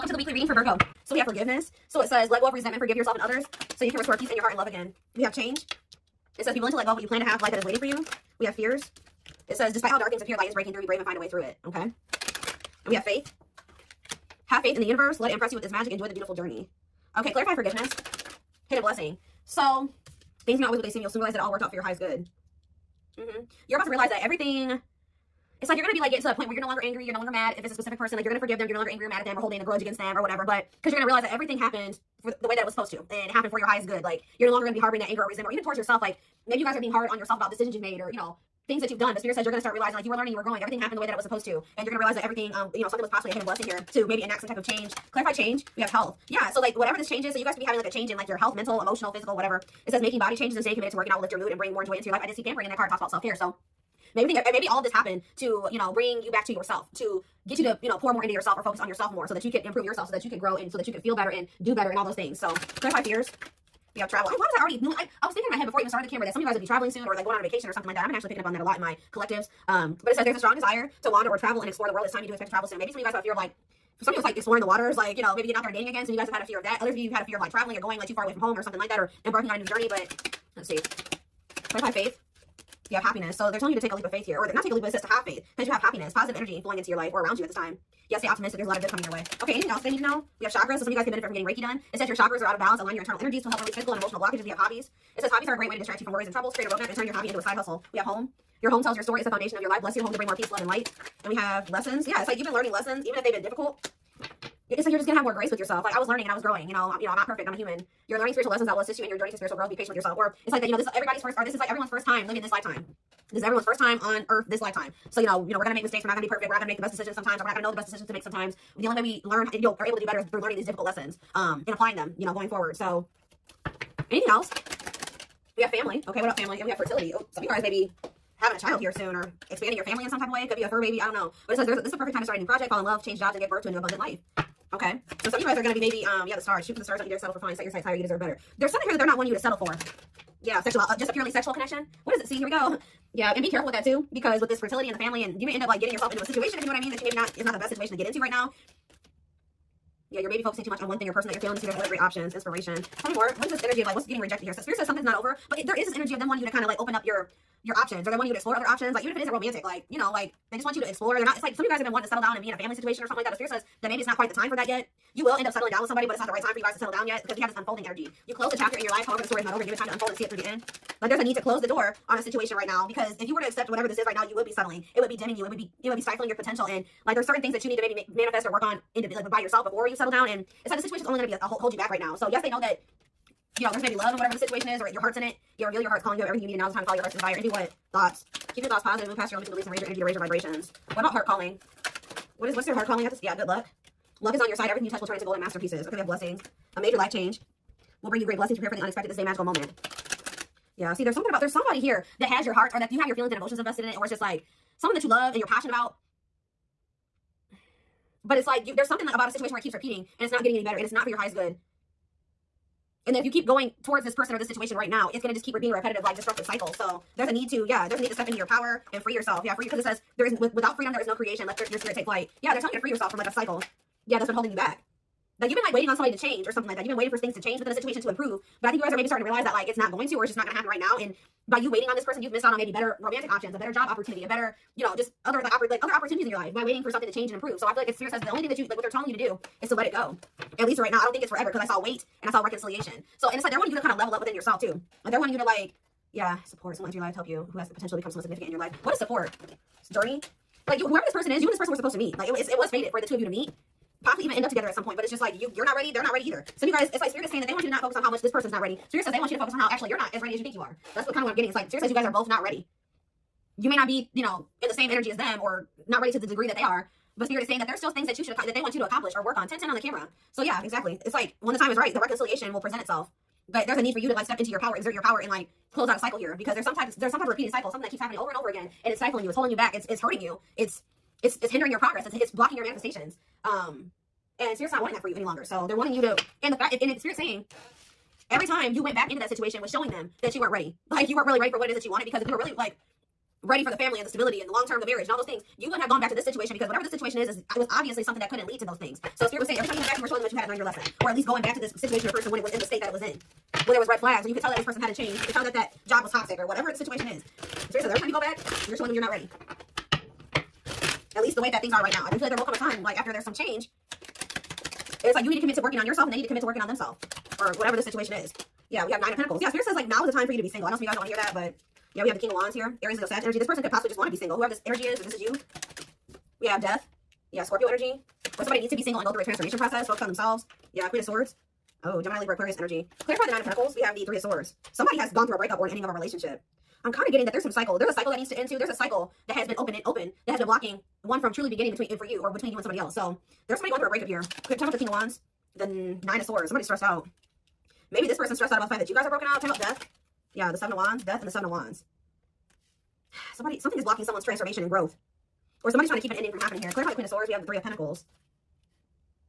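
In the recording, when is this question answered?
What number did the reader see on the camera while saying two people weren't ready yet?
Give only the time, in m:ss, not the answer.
4:29.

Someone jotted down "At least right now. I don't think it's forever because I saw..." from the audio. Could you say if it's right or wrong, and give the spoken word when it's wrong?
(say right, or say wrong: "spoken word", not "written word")
right.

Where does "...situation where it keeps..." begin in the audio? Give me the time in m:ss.
3:29.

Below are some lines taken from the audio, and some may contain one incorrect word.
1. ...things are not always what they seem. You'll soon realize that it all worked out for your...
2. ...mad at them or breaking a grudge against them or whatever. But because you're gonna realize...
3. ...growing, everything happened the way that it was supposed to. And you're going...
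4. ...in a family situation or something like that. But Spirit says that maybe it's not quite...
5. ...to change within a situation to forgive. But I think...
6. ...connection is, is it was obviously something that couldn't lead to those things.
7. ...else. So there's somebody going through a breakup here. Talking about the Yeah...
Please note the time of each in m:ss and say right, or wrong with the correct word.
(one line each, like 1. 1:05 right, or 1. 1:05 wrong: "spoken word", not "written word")
1. 0:20 right
2. 0:29 wrong: "holding", not "breaking"
3. 0:40 right
4. 2:42 right
5. 3:47 wrong: "improve", not "forgive"
6. 4:56 wrong: "situation", not "connection"
7. 5:42 wrong: "King", not "Yeah".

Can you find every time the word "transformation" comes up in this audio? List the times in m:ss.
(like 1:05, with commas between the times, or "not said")
5:29, 5:54.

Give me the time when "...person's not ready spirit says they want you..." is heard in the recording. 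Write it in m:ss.
4:18.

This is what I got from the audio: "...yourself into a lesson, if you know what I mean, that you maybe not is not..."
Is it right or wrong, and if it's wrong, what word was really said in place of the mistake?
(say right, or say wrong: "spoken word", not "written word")
wrong: "situation", not "lesson".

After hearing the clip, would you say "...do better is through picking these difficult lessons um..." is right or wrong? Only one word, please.
wrong.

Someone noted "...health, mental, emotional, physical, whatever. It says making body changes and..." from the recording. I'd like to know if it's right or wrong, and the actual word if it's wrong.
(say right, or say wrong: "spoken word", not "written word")
right.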